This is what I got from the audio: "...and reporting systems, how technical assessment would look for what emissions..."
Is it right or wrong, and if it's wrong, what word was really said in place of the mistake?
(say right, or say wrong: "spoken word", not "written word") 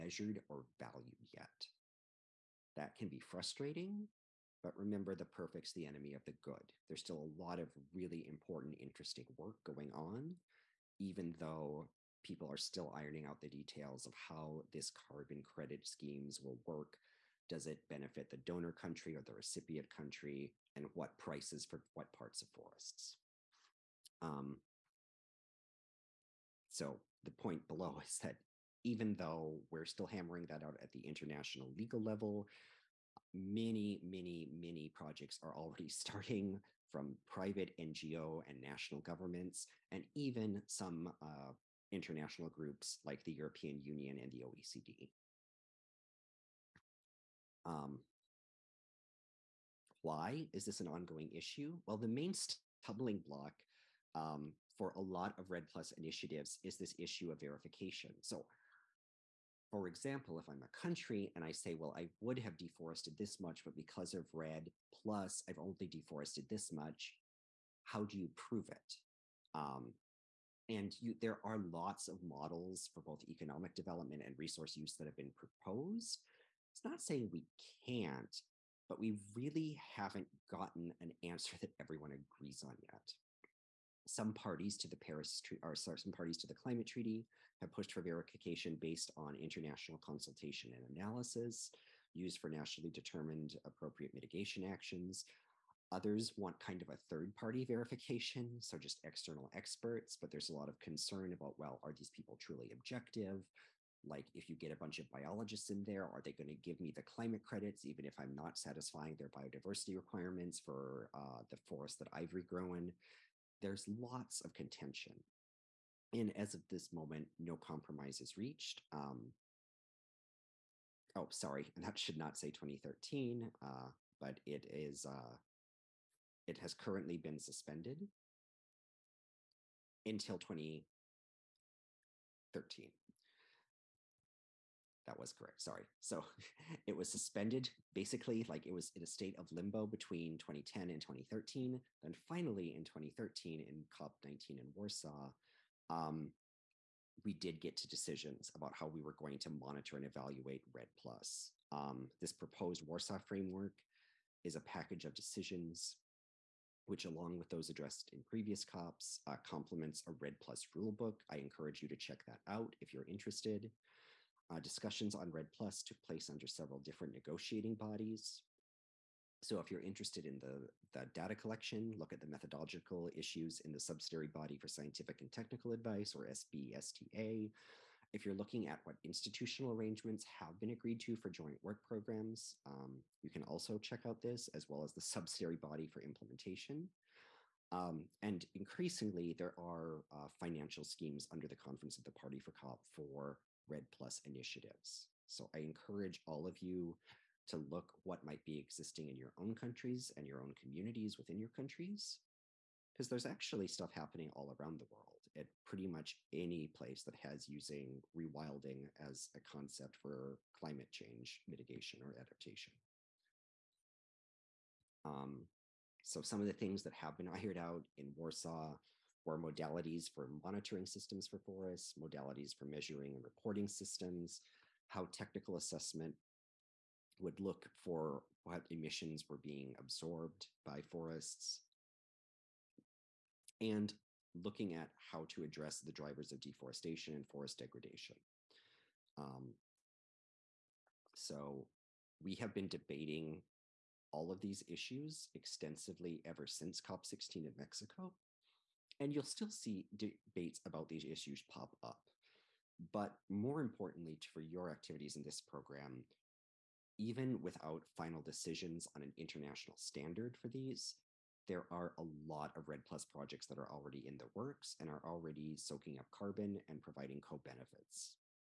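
right.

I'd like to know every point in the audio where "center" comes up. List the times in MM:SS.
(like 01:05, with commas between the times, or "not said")
not said.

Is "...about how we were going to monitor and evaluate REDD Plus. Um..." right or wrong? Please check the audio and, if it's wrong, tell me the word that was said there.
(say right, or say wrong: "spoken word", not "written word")
right.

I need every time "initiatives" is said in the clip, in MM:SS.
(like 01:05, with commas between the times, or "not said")
00:55, 03:14.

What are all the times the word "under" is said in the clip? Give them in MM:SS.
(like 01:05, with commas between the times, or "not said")
02:46, 03:11.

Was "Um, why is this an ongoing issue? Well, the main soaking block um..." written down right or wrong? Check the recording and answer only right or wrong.
wrong.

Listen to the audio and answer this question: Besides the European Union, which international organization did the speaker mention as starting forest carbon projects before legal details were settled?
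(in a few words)
OECD.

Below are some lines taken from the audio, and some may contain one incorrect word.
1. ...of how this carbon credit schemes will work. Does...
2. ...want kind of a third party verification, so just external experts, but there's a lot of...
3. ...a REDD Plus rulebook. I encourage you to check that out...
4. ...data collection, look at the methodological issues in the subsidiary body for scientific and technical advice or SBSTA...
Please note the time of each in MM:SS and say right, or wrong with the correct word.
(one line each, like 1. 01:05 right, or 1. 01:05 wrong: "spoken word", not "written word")
1. 00:14 right
2. 01:36 right
3. 02:40 right
4. 02:51 right.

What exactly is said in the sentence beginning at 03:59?
Um, so we have been debating all of these issues extensively ever since COP16 in Mexico.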